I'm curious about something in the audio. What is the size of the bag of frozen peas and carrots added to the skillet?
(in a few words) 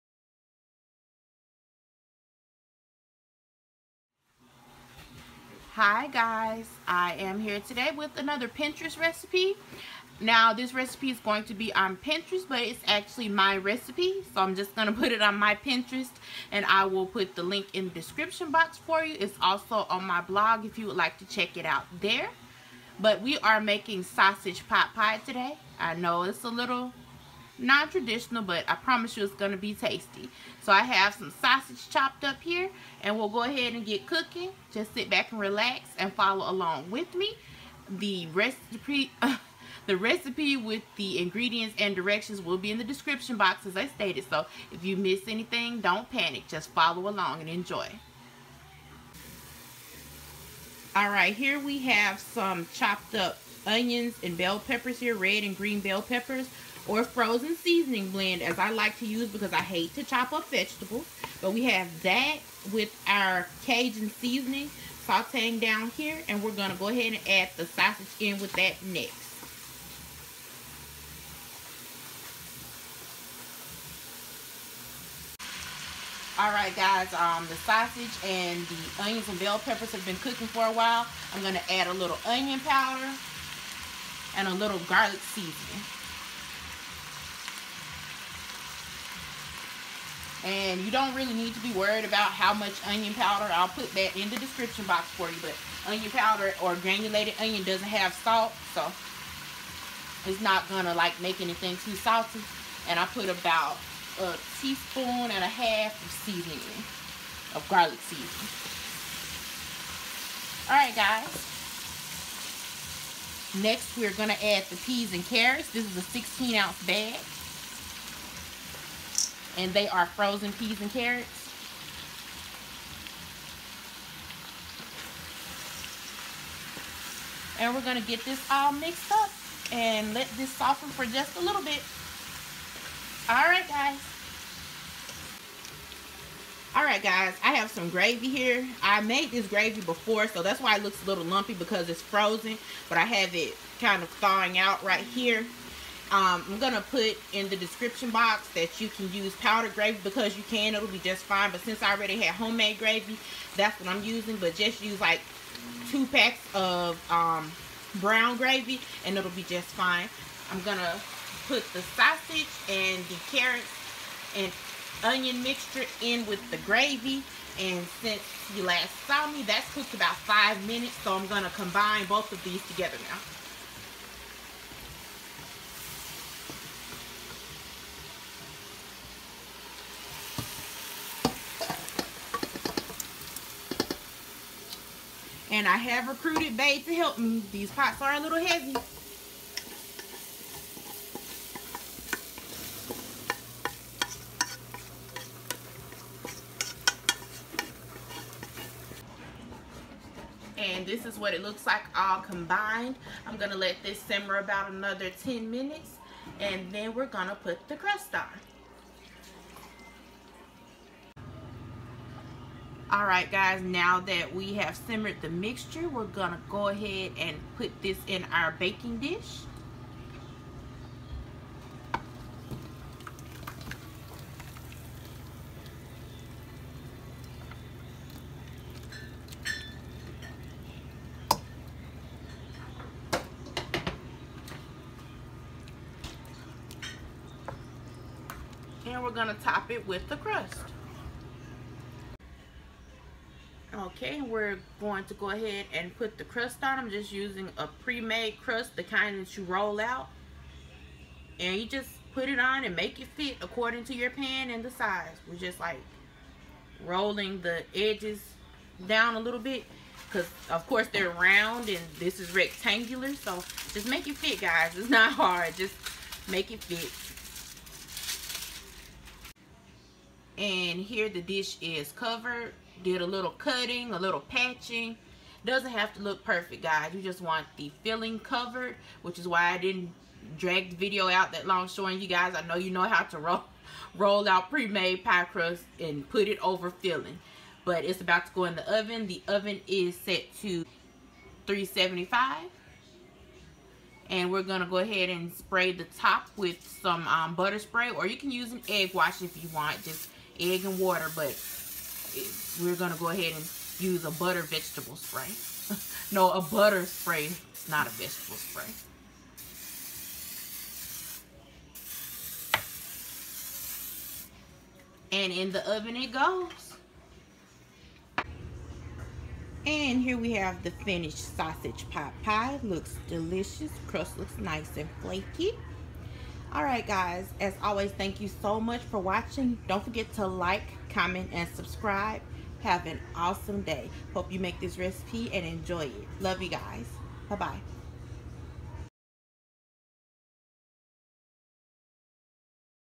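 16 ounces.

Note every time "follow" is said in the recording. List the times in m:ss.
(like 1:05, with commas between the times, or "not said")
0:36, 0:46.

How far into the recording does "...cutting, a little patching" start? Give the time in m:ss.
4:33.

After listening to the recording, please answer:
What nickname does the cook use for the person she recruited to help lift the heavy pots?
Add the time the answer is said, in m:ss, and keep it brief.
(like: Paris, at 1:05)
Babe, at 3:06.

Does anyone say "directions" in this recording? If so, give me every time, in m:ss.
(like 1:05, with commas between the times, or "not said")
0:41.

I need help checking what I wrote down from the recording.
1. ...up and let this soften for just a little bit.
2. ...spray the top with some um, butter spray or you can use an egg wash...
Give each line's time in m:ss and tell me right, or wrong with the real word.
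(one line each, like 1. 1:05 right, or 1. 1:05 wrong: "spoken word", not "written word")
1. 2:09 right
2. 4:55 right.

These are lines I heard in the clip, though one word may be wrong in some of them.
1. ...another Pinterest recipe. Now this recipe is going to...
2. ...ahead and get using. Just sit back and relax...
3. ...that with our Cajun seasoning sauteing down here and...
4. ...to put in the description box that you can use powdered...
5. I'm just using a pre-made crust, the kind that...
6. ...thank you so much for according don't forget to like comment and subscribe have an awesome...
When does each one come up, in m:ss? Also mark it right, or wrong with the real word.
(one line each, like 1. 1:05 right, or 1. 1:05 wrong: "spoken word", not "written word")
1. 0:08 right
2. 0:33 wrong: "cooking", not "using"
3. 1:02 right
4. 2:26 right
5. 4:06 right
6. 5:27 wrong: "watching", not "according".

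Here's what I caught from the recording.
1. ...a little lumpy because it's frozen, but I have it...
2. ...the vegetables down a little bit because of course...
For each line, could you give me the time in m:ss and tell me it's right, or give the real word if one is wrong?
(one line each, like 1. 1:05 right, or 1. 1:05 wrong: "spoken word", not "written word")
1. 2:21 right
2. 4:17 wrong: "edges", not "vegetables".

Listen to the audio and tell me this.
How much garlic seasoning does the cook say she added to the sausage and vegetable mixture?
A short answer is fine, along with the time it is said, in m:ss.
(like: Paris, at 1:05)
1.5 teaspoons, at 1:44.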